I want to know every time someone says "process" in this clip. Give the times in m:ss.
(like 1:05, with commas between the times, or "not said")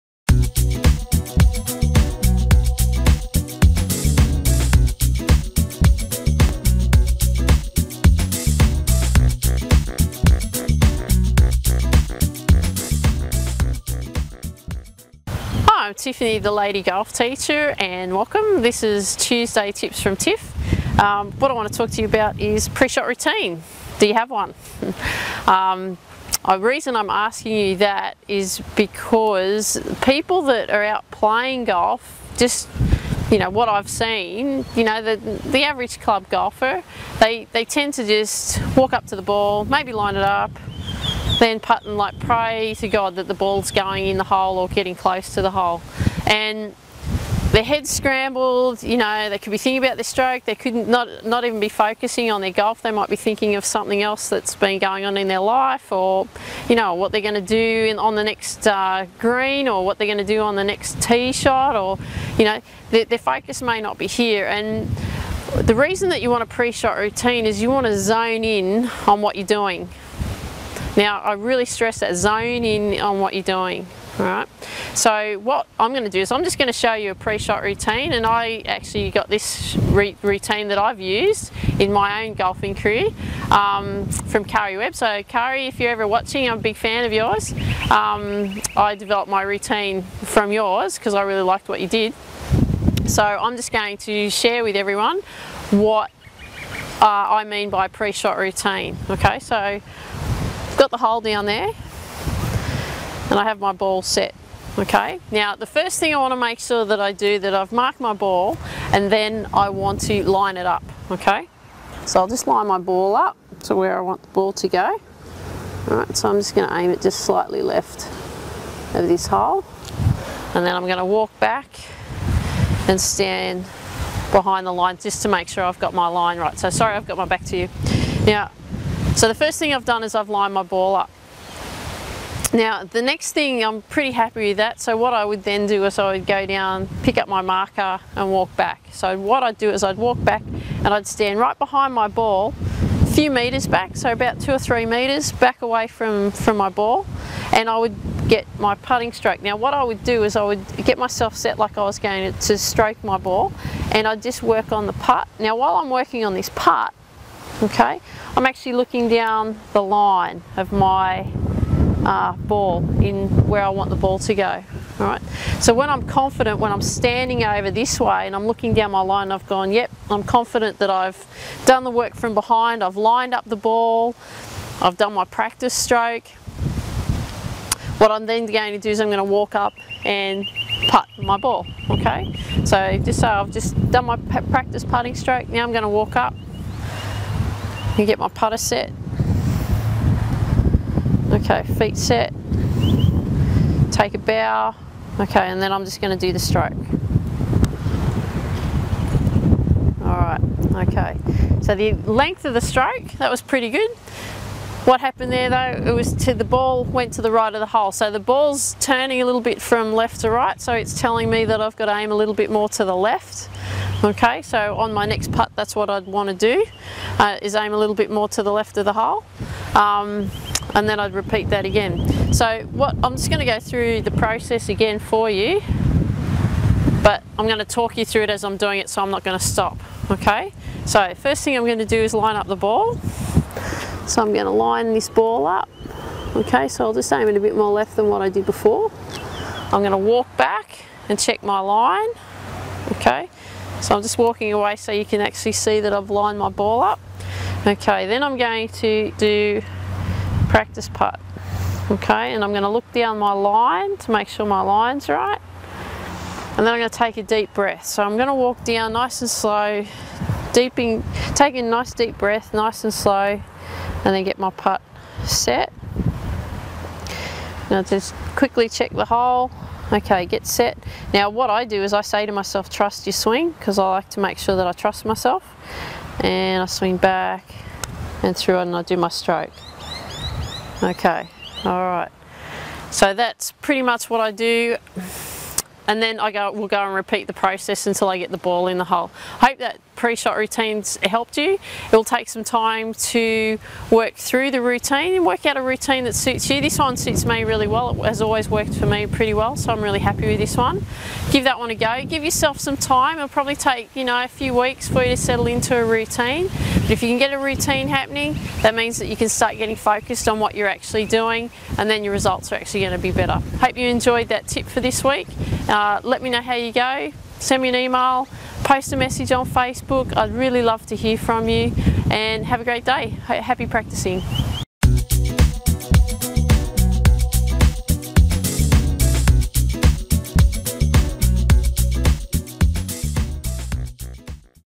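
3:44, 4:47.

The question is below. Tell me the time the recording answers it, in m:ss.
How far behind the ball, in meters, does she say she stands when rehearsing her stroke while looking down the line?
2:24.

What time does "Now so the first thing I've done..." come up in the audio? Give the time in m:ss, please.
2:08.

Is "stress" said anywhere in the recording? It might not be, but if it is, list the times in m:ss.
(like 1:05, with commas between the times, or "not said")
1:11.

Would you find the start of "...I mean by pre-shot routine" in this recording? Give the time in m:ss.
1:37.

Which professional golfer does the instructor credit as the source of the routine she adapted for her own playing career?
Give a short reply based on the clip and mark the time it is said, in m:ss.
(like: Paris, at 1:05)
Karrie Webb, at 1:24.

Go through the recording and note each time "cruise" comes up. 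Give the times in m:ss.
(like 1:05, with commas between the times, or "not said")
not said.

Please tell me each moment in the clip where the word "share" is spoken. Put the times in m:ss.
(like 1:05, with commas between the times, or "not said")
1:34.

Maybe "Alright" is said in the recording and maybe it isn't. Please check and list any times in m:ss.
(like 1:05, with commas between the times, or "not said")
1:14, 1:55, 3:20.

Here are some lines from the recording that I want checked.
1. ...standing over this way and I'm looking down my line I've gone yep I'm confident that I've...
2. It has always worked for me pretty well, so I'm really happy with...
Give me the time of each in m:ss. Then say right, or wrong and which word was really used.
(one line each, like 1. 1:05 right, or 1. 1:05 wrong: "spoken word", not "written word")
1. 2:46 right
2. 4:58 right.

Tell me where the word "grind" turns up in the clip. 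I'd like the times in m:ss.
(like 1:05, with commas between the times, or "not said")
not said.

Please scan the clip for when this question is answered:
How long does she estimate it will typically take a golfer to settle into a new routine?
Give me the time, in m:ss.
5:04.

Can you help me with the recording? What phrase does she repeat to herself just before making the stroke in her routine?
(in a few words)
Trust your swing.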